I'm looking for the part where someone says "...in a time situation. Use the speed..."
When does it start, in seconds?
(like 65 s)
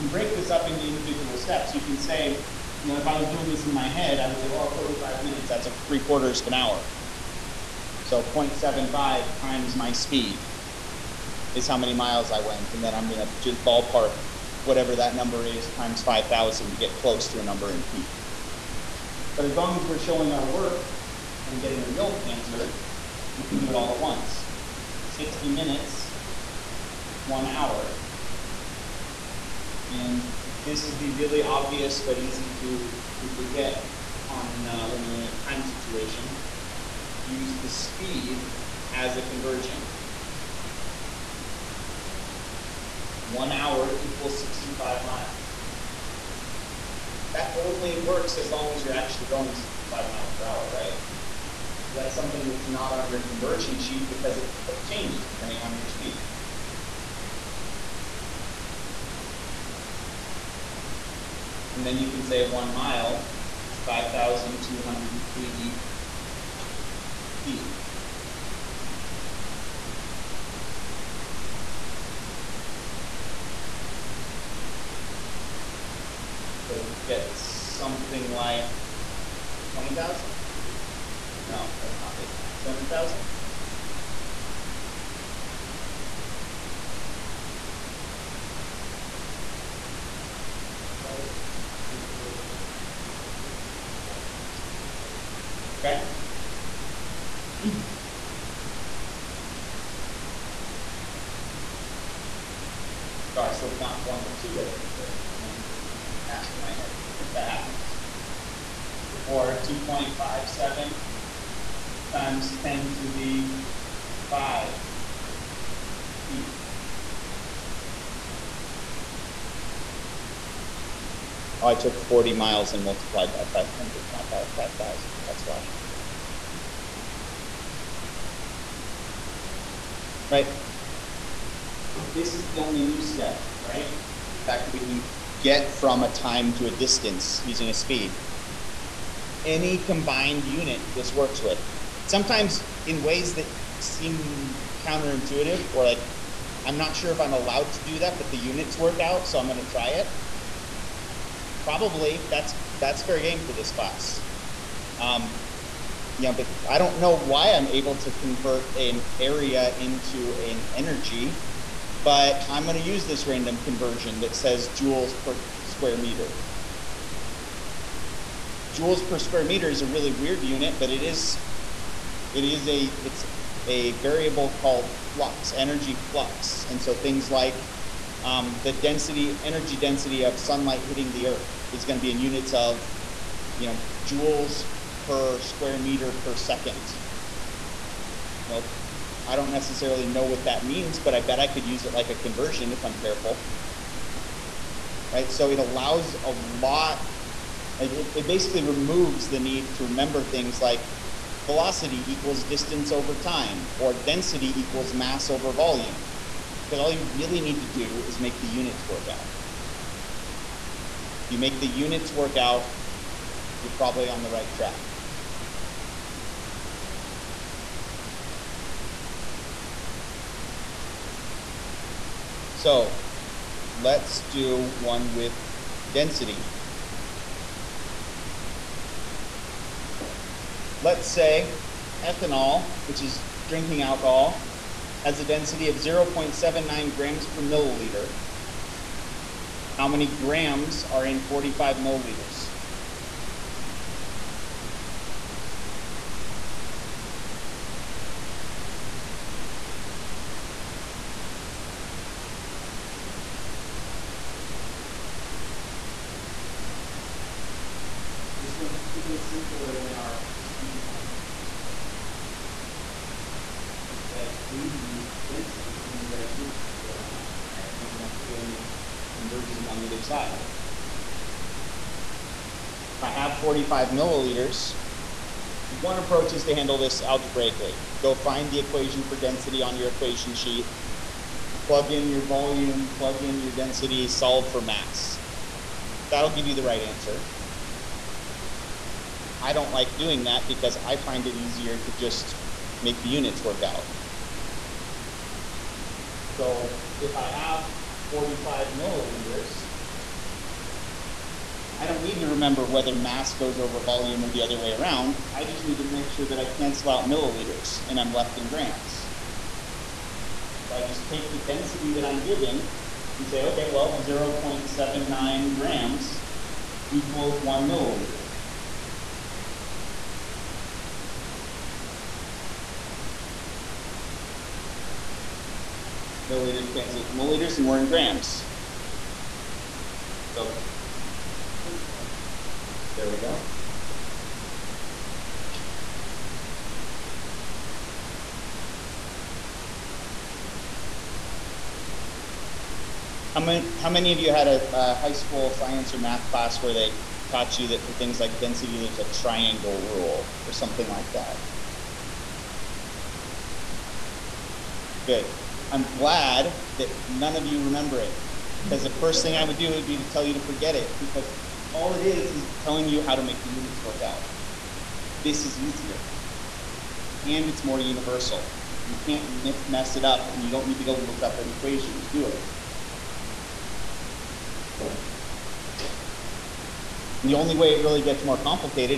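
35 s.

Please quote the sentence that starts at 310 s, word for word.
So I just take the density that I'm given and say, okay, well, 0.79 grams equals one milliliter.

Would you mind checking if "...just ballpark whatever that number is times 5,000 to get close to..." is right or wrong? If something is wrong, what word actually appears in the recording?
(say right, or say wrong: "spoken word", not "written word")
right.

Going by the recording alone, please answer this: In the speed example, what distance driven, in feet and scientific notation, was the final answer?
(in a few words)
2.57 times 10 to the 5 feet.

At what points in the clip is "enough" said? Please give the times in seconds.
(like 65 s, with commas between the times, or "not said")
82 s.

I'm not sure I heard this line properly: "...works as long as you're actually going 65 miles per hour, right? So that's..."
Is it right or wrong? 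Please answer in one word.
right.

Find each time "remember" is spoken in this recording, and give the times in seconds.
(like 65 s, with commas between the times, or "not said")
199 s, 302 s, 357 s.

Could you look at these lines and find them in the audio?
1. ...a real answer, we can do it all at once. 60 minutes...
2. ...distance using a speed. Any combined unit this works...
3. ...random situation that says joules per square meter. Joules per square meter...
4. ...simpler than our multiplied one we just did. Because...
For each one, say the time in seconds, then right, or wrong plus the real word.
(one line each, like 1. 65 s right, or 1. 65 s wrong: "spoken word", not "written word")
1. 21 s right
2. 136 s right
3. 163 s wrong: "conversion", not "situation"
4. 259 s wrong: "speed", not "multiplied".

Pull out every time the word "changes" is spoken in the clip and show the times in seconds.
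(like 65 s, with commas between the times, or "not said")
54 s.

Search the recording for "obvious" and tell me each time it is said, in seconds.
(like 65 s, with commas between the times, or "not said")
31 s.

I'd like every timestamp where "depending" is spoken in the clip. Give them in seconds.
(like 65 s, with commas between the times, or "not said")
55 s.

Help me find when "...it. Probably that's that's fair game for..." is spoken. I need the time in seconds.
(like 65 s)
149 s.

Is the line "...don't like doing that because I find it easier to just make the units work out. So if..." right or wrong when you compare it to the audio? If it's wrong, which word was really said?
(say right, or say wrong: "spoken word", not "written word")
right.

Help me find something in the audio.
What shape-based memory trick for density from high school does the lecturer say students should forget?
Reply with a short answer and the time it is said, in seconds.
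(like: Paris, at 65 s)
triangle rule, at 349 s.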